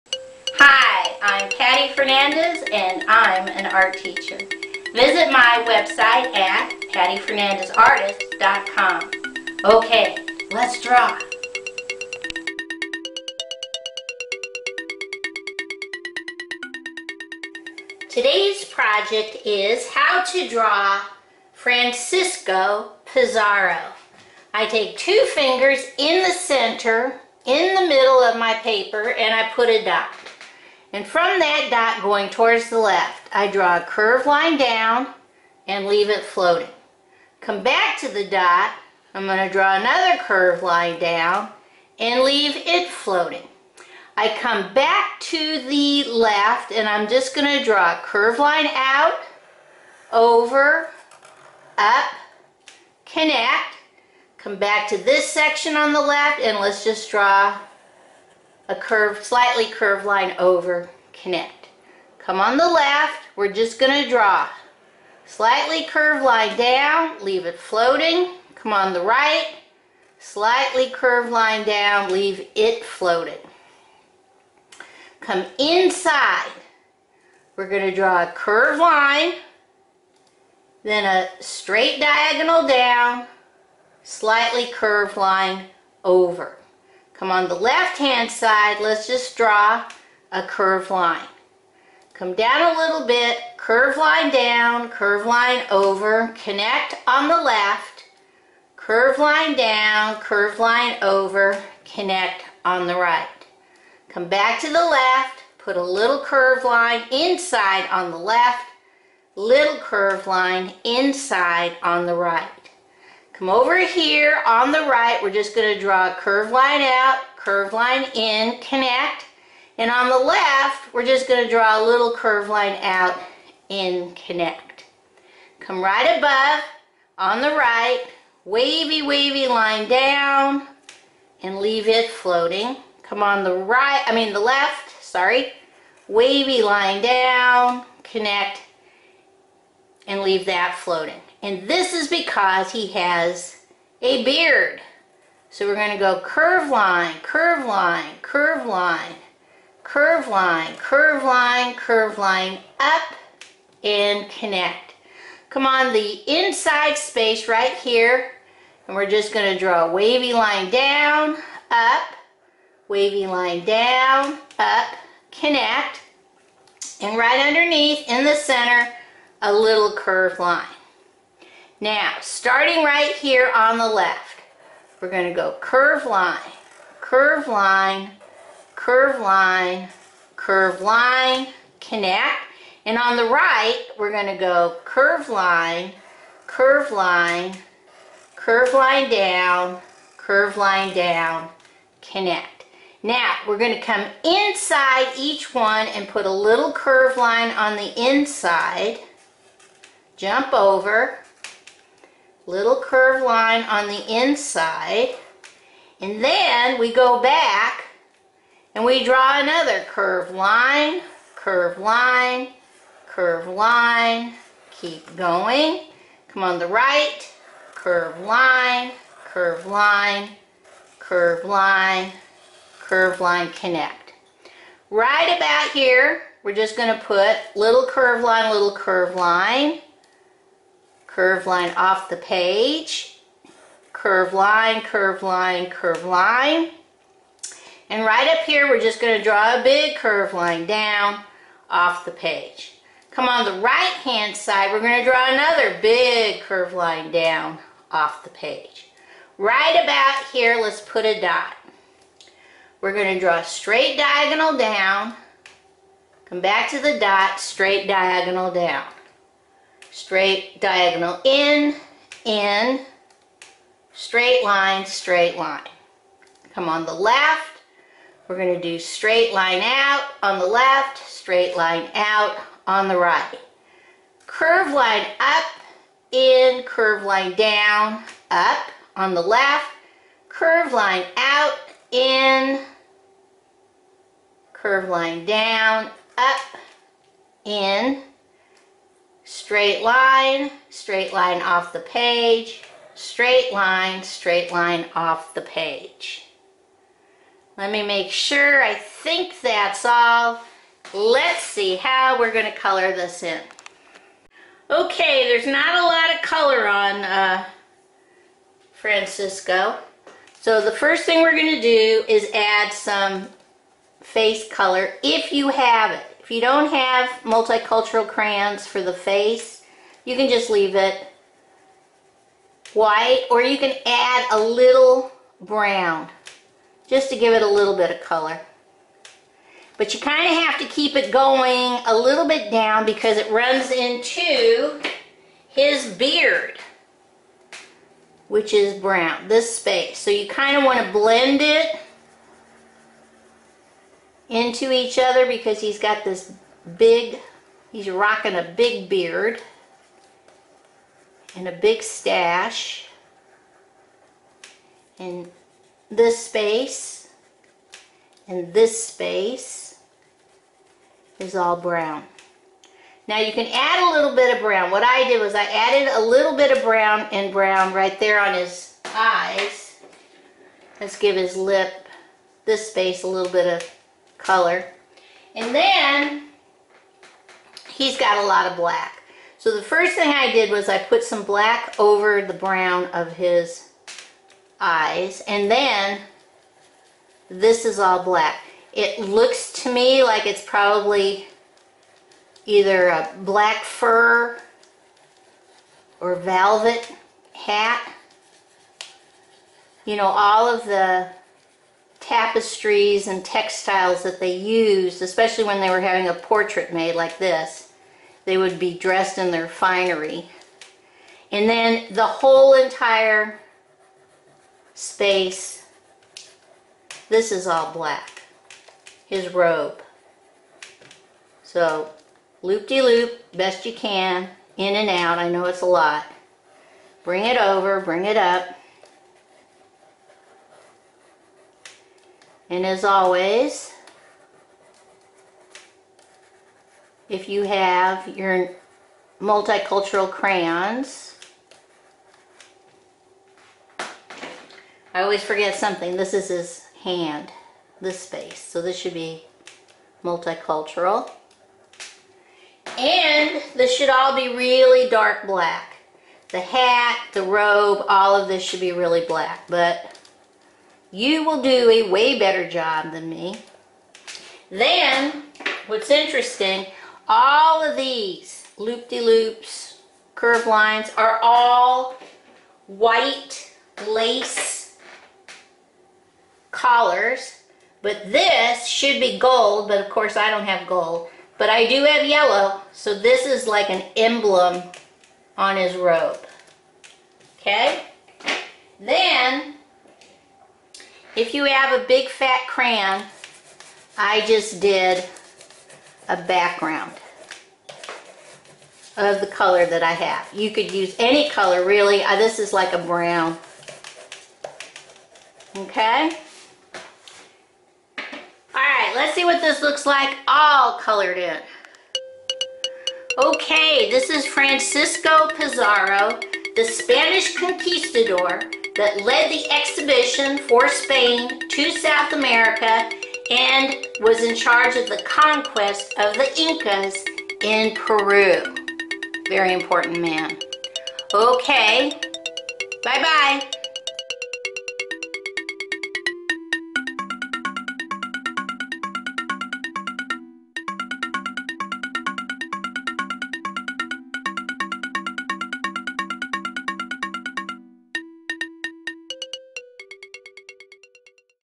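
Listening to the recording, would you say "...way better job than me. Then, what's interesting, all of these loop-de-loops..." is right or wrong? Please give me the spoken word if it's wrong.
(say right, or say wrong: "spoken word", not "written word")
right.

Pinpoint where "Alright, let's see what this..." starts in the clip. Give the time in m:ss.
8:28.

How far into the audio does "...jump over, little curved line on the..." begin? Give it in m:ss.
3:20.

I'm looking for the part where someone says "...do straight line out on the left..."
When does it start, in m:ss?
4:28.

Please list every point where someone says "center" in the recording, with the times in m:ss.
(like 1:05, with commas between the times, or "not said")
0:26, 2:48.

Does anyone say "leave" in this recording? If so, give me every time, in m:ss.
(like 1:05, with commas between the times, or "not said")
0:35, 0:42, 1:07, 1:12, 2:11, 2:20, 5:20.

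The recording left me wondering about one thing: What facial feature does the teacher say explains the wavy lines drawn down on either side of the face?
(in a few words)
a beard.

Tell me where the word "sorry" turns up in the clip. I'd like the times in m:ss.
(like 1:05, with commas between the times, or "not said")
2:15.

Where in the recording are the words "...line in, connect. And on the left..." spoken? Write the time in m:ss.
1:57.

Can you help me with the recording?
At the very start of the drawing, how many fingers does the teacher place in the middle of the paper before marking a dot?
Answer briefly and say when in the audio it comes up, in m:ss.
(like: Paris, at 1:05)
2, at 0:24.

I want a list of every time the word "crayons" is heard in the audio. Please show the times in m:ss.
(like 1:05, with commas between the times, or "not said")
5:18, 7:20, 8:12.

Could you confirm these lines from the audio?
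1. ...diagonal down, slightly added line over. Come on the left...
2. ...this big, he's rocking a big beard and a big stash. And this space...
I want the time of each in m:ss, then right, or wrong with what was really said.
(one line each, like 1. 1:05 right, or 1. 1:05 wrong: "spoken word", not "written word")
1. 1:21 wrong: "curved", not "added"
2. 5:46 right.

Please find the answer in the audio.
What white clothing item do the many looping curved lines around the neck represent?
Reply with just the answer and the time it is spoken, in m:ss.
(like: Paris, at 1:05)
white lace collars, at 7:52.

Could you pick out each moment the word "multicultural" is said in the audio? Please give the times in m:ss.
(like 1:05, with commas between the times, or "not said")
5:17, 7:19, 7:30.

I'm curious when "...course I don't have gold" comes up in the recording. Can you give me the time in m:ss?
7:59.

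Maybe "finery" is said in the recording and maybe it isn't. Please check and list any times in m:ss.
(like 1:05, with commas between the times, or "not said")
6:49.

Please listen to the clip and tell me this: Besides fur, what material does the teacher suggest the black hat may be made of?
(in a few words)
velvet.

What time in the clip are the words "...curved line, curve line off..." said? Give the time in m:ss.
3:48.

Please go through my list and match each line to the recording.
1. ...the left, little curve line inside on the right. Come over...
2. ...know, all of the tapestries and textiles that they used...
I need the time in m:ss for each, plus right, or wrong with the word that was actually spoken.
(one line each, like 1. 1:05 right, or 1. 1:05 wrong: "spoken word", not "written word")
1. 1:48 right
2. 6:39 right.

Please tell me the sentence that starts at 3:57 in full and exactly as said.
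And right up here, we're just going to draw a big curve line down off the page.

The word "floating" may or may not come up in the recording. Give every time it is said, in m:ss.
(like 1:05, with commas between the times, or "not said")
0:36, 0:42, 1:07, 1:12, 2:12, 2:20.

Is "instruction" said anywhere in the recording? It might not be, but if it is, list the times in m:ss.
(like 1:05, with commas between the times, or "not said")
not said.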